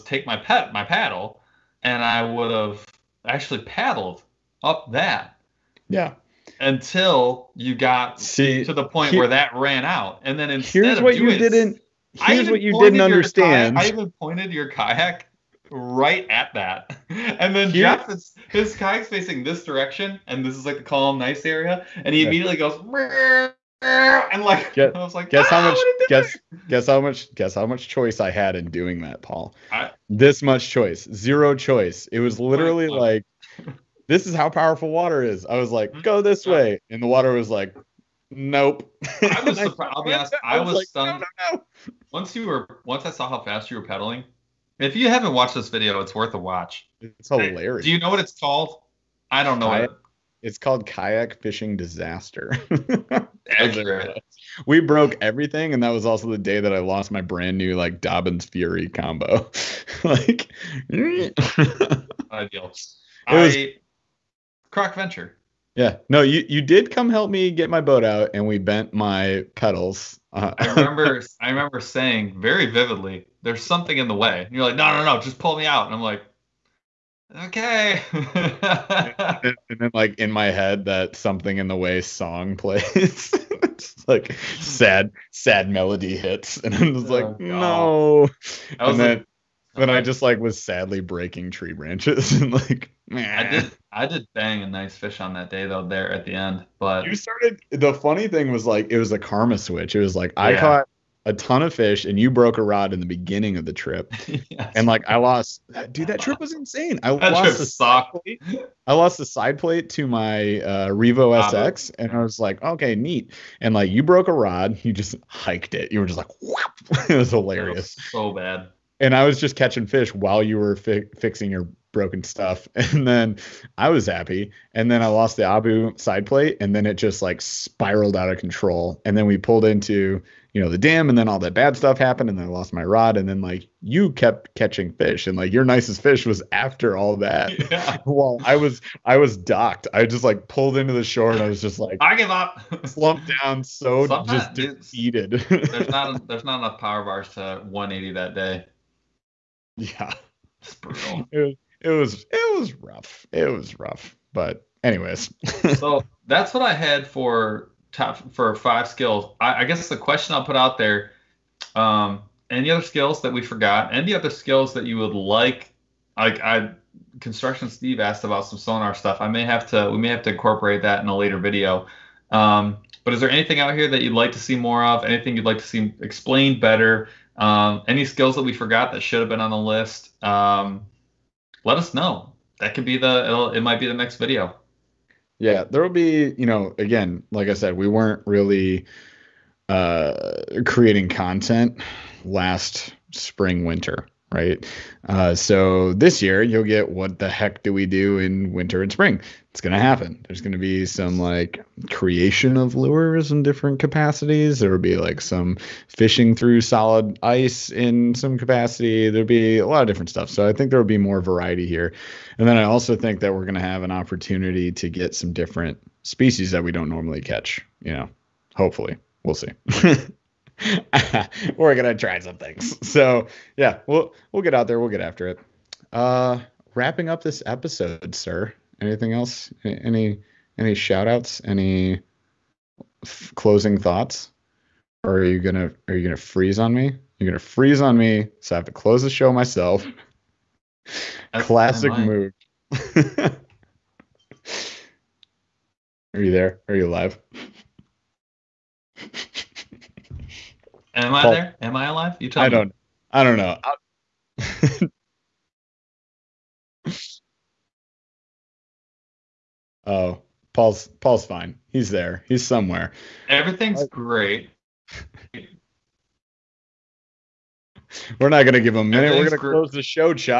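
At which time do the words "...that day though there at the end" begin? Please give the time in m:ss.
1:35.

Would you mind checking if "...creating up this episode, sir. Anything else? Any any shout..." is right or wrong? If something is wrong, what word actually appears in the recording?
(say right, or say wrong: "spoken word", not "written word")
wrong: "wrapping", not "creating".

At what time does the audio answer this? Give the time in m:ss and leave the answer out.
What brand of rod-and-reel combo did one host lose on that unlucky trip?
0:58.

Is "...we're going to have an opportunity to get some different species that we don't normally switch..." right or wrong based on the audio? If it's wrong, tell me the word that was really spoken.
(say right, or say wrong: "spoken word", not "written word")
wrong: "catch", not "switch".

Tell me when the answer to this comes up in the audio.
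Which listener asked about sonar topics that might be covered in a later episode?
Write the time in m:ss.
2:47.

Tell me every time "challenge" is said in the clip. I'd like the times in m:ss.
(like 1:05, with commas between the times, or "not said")
not said.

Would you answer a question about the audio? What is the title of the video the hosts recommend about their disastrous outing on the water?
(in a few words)
Kayak fishing disaster.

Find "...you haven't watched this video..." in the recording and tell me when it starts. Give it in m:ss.
0:44.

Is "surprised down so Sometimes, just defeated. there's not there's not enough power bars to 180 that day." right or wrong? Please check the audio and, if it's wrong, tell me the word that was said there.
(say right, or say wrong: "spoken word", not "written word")
wrong: "slumped", not "surprised".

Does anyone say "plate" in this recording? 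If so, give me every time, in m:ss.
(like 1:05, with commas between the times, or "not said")
1:49, 2:06.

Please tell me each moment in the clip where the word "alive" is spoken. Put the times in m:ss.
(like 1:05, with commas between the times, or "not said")
4:06, 4:11.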